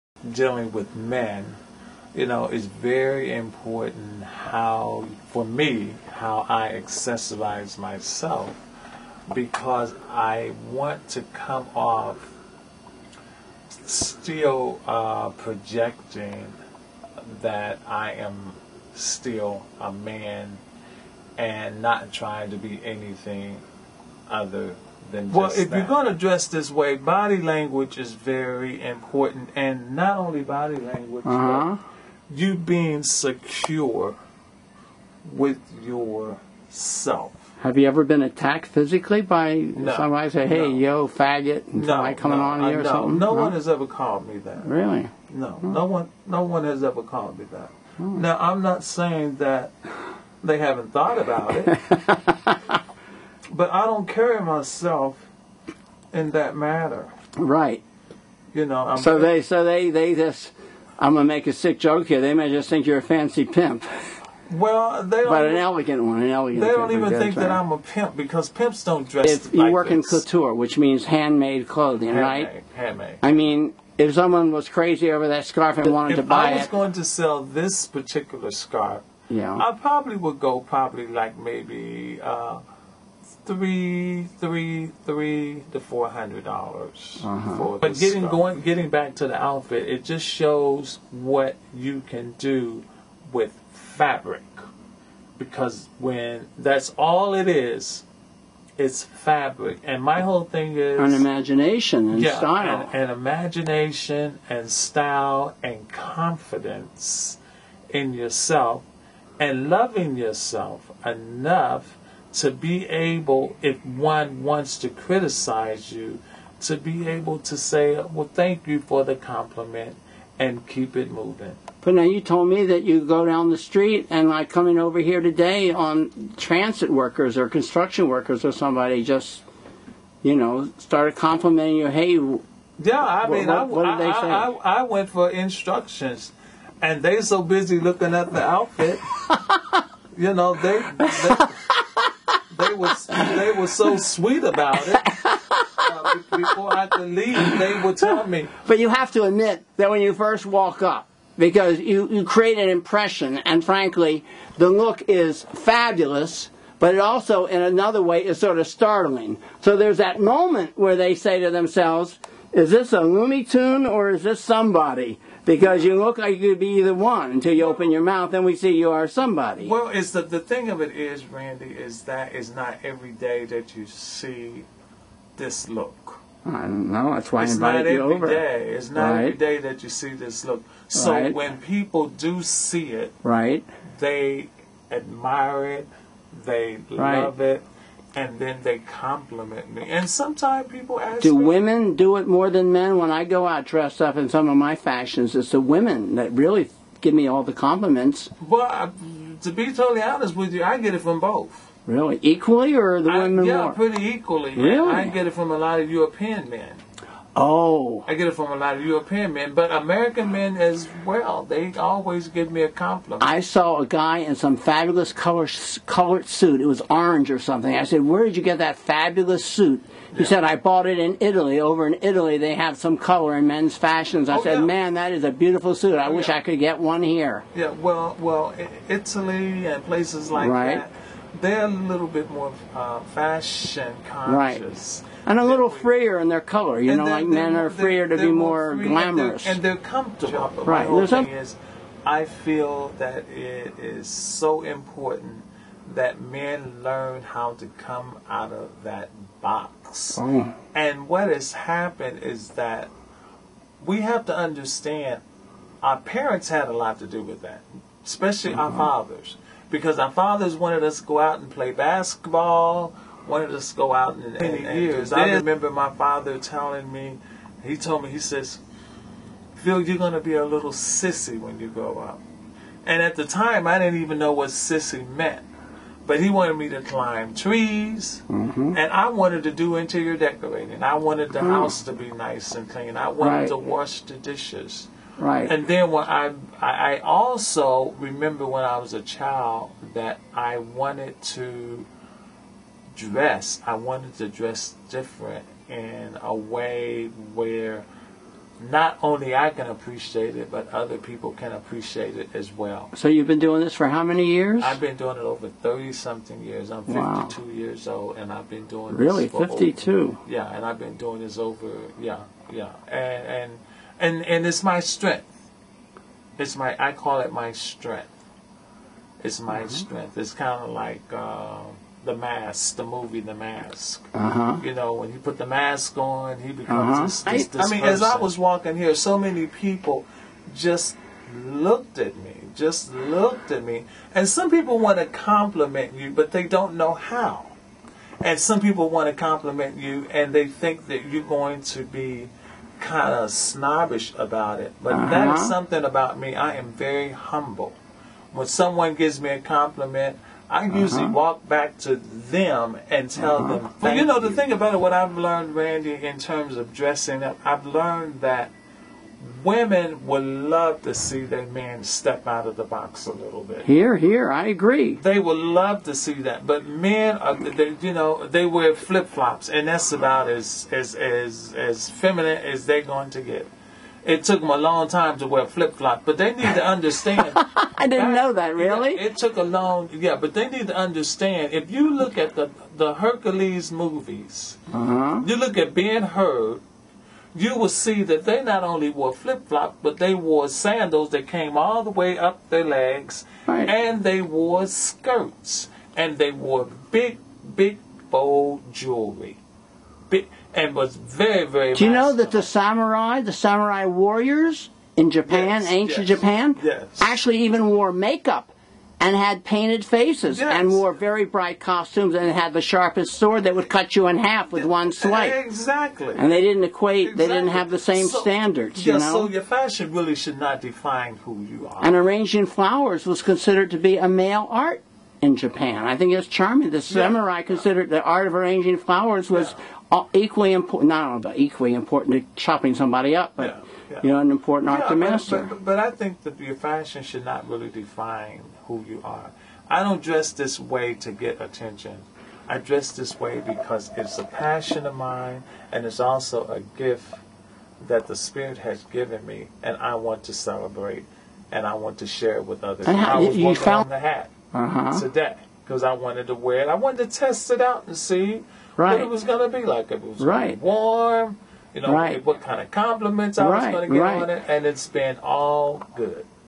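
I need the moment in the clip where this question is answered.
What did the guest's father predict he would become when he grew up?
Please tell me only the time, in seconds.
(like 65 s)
270 s.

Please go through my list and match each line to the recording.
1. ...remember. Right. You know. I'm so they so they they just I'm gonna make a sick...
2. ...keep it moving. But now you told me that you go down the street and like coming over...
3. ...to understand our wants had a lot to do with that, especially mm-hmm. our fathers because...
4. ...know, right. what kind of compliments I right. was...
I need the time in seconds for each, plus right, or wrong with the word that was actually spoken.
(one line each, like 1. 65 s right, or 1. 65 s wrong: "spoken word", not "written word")
1. 56 s wrong: "manner", not "remember"
2. 120 s right
3. 254 s wrong: "parents", not "wants"
4. 461 s right.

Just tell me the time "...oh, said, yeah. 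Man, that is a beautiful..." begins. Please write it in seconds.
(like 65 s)
224 s.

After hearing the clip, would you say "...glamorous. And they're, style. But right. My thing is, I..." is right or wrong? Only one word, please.
wrong.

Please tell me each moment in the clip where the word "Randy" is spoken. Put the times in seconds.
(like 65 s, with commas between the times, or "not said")
171 s, 355 s.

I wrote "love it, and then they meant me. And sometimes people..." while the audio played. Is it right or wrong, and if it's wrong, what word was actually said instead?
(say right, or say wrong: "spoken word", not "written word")
wrong: "compliment", not "meant".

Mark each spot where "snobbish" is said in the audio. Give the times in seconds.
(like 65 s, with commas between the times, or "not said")
343 s.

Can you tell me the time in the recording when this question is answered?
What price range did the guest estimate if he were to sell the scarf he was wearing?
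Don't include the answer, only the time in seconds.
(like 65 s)
85 s.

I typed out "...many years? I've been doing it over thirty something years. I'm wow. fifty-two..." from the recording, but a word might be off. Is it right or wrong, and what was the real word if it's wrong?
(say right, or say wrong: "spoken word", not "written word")
right.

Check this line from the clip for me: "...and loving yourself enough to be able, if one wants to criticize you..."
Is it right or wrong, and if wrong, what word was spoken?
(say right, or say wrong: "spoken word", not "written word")
right.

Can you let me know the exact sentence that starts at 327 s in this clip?
this, this, this I, I mean, person.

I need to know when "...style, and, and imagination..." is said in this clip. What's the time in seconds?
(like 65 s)
102 s.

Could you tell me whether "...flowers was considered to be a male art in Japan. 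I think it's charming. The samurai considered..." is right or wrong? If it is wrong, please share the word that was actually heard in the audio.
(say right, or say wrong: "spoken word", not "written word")
right.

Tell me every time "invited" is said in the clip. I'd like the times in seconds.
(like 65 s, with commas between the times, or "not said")
177 s.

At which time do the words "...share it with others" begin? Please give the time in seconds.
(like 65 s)
452 s.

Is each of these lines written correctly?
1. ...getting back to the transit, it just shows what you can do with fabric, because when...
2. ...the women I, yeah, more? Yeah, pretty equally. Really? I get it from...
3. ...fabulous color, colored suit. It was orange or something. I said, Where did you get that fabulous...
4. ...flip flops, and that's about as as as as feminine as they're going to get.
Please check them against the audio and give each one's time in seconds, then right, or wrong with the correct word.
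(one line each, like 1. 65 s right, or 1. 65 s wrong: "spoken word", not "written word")
1. 88 s wrong: "outfit", not "transit"
2. 203 s right
3. 214 s right
4. 368 s right.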